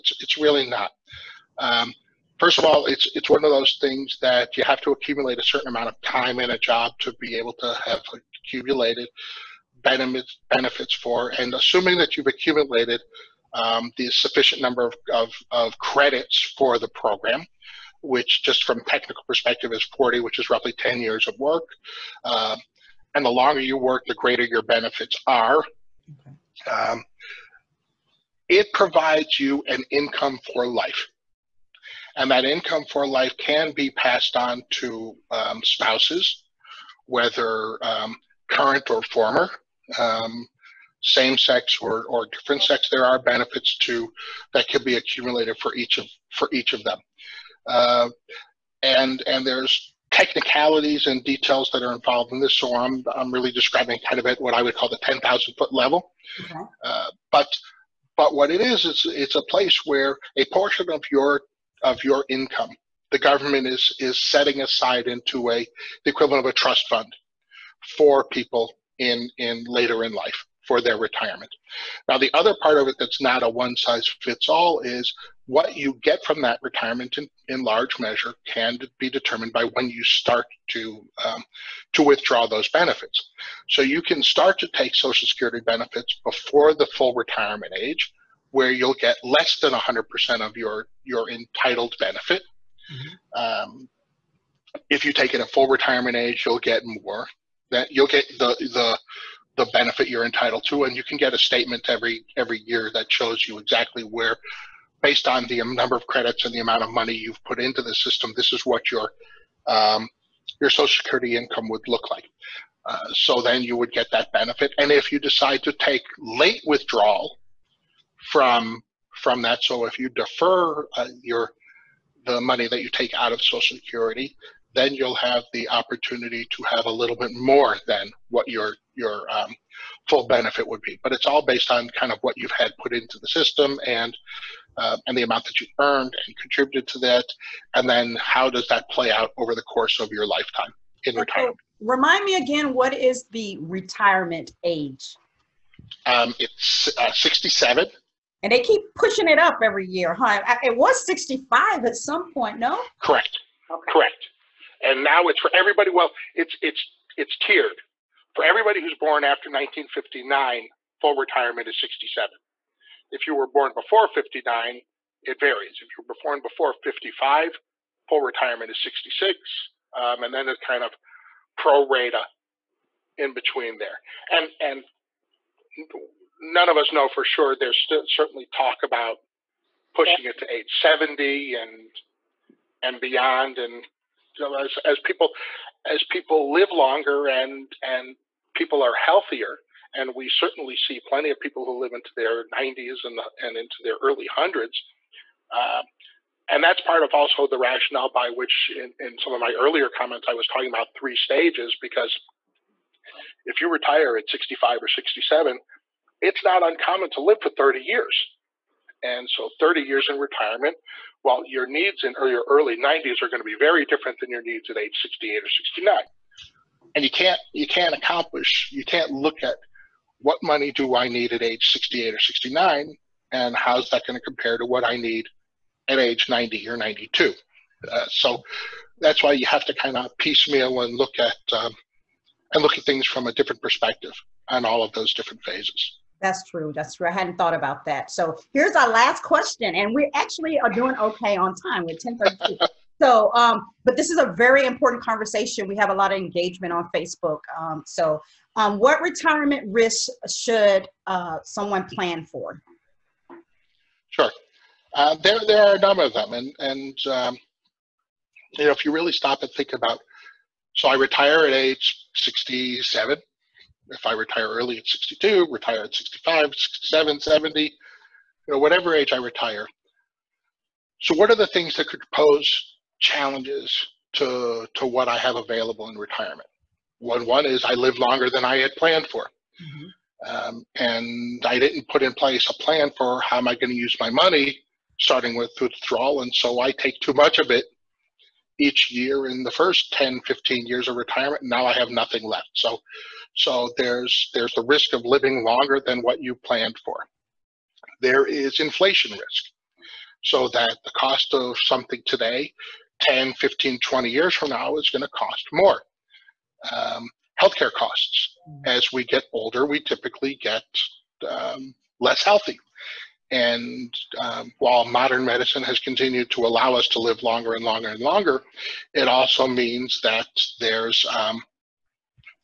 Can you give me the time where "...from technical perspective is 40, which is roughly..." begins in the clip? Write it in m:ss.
0:18.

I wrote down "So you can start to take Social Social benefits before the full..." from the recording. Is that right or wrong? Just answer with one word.
wrong.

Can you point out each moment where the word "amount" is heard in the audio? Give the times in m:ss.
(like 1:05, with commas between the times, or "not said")
0:05, 1:46, 2:15.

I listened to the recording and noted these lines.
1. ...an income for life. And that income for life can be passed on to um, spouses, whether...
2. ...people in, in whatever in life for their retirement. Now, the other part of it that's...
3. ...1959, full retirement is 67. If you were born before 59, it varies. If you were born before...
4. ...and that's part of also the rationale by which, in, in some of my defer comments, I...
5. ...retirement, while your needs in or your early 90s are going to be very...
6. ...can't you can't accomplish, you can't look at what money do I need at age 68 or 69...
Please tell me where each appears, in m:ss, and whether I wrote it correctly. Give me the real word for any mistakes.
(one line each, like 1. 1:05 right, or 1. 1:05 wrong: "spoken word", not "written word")
1. 0:29 right
2. 1:08 wrong: "later", not "whatever"
3. 2:39 right
4. 3:16 wrong: "earlier", not "defer"
5. 3:30 right
6. 3:37 right.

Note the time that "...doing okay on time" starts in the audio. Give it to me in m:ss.
4:00.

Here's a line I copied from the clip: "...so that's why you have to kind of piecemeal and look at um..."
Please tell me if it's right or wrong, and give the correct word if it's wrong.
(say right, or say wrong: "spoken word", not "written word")
right.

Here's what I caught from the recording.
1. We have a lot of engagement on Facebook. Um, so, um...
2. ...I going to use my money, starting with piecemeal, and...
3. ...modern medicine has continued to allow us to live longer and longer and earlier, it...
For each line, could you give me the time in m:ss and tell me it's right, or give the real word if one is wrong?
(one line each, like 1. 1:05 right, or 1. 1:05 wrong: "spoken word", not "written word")
1. 4:05 right
2. 4:43 wrong: "withdrawal", not "piecemeal"
3. 5:14 wrong: "longer", not "earlier".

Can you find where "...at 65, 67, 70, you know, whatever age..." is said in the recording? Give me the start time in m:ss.
4:25.